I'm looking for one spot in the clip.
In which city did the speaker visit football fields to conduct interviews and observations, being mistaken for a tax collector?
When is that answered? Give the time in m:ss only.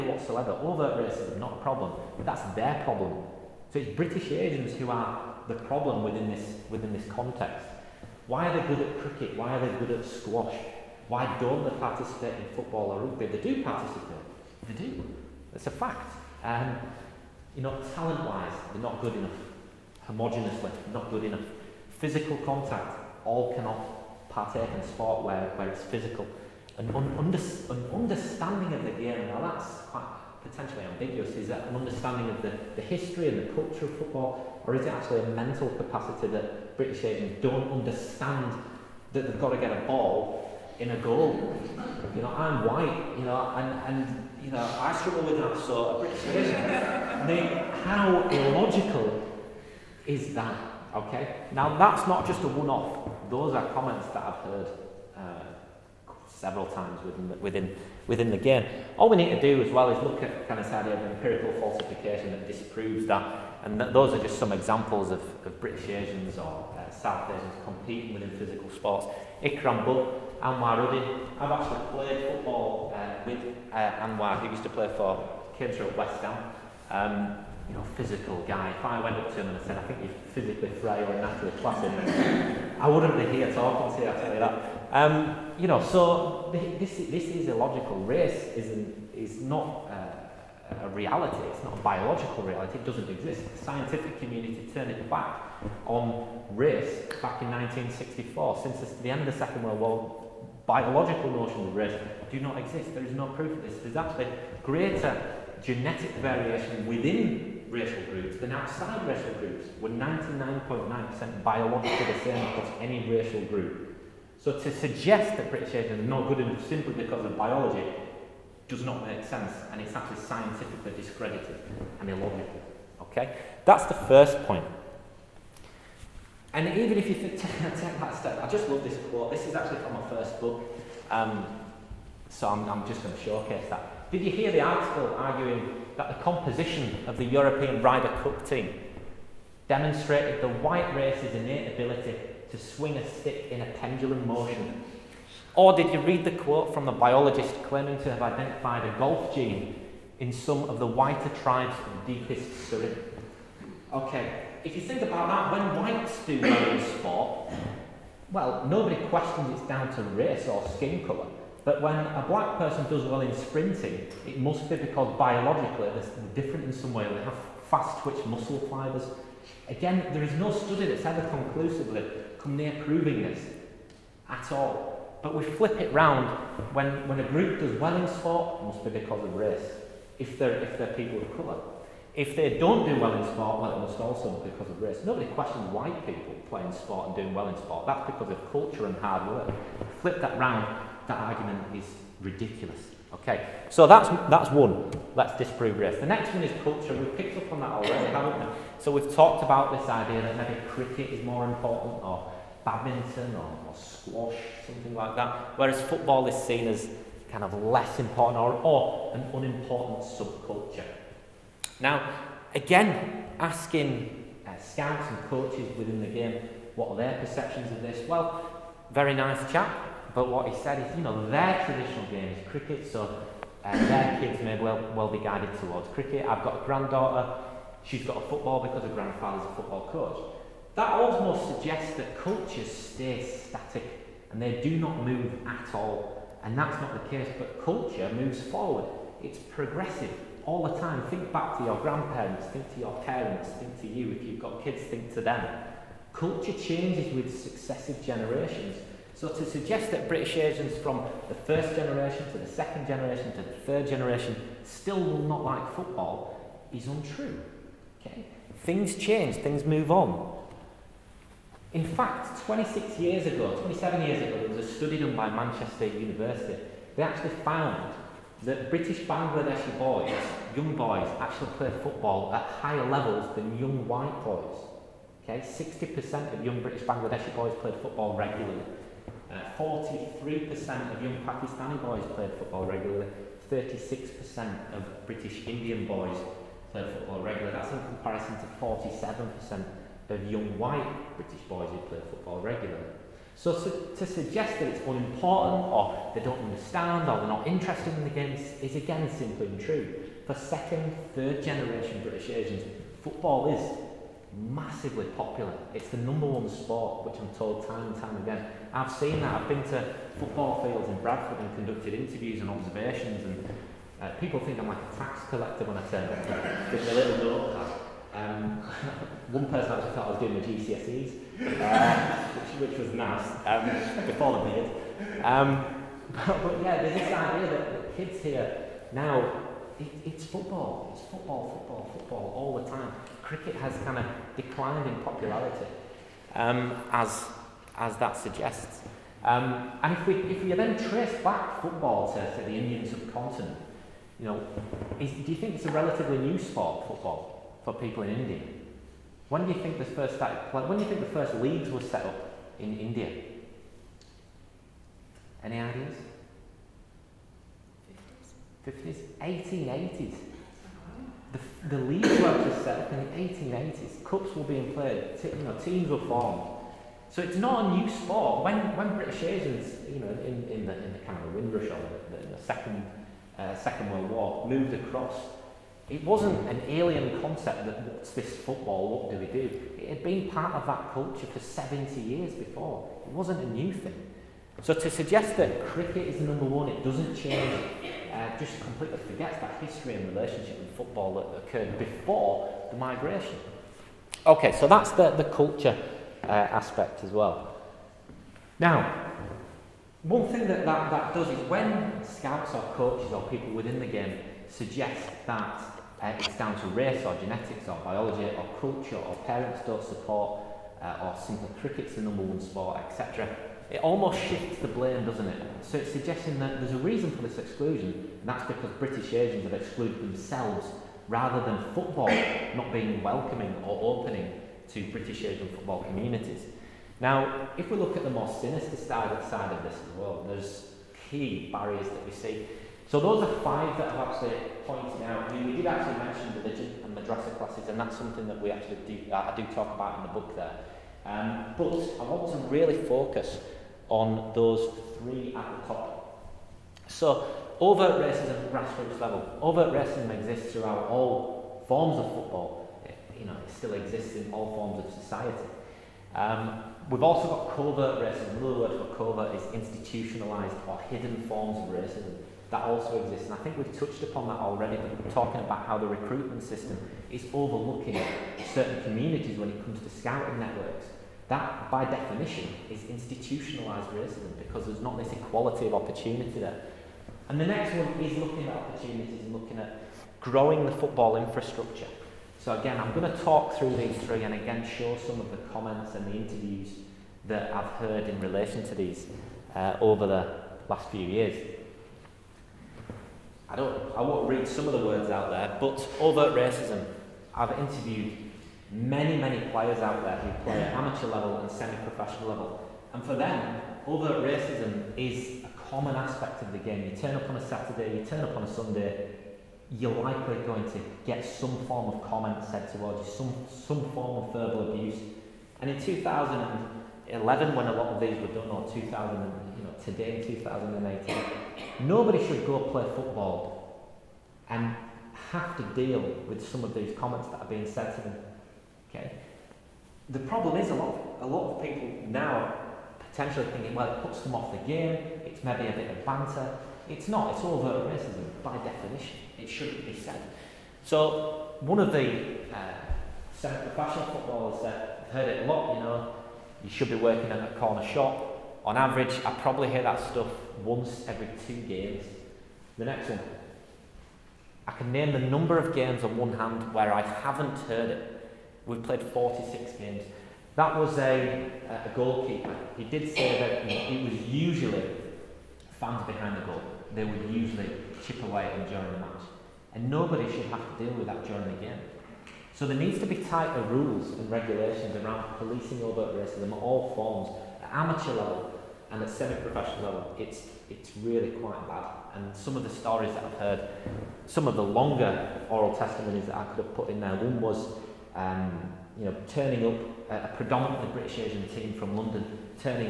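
5:11.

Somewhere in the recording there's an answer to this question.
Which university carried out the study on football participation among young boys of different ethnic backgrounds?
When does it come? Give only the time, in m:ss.
4:25.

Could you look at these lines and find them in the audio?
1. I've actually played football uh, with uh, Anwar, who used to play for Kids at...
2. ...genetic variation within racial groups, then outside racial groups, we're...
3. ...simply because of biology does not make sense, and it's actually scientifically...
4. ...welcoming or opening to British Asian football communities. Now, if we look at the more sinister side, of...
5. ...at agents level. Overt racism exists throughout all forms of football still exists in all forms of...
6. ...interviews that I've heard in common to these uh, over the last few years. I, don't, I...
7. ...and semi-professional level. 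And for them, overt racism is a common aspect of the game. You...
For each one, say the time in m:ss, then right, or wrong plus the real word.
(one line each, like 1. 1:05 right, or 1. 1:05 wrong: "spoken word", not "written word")
1. 1:11 right
2. 1:45 right
3. 1:56 right
4. 7:03 right
5. 7:28 wrong: "grassroots", not "agents"
6. 8:06 wrong: "relation", not "common"
7. 8:21 right.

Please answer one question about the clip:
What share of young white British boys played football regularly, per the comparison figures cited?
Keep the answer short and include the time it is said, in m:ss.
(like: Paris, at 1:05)
47%, at 4:48.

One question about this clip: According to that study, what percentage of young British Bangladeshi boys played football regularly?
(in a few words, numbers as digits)
60%.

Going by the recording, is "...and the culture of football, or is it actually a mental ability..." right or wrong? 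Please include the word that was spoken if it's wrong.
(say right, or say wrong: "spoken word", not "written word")
wrong: "capacity", not "ability".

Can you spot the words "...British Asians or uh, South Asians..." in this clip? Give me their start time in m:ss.
1:05.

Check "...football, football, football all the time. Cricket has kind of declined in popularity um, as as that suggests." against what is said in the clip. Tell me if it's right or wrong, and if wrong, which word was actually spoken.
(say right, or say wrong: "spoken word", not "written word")
right.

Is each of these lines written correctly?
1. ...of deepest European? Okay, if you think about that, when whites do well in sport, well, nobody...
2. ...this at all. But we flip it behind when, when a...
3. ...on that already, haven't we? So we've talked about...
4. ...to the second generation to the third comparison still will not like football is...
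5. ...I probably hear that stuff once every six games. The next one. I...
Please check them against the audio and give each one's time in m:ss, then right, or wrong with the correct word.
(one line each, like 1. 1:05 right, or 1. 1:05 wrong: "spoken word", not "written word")
1. 2:31 wrong: "Surrey", not "European"
2. 2:53 wrong: "round", not "behind"
3. 3:17 right
4. 4:12 wrong: "generation", not "comparison"
5. 9:09 wrong: "two", not "six".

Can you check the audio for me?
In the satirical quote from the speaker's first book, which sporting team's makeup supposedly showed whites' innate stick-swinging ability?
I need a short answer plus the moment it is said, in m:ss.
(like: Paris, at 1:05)
European Ryder Cup team, at 2:17.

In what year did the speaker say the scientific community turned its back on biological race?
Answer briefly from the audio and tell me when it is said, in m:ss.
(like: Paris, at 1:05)
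1964, at 1:37.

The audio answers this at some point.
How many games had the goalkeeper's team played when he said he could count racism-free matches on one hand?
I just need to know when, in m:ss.
9:19.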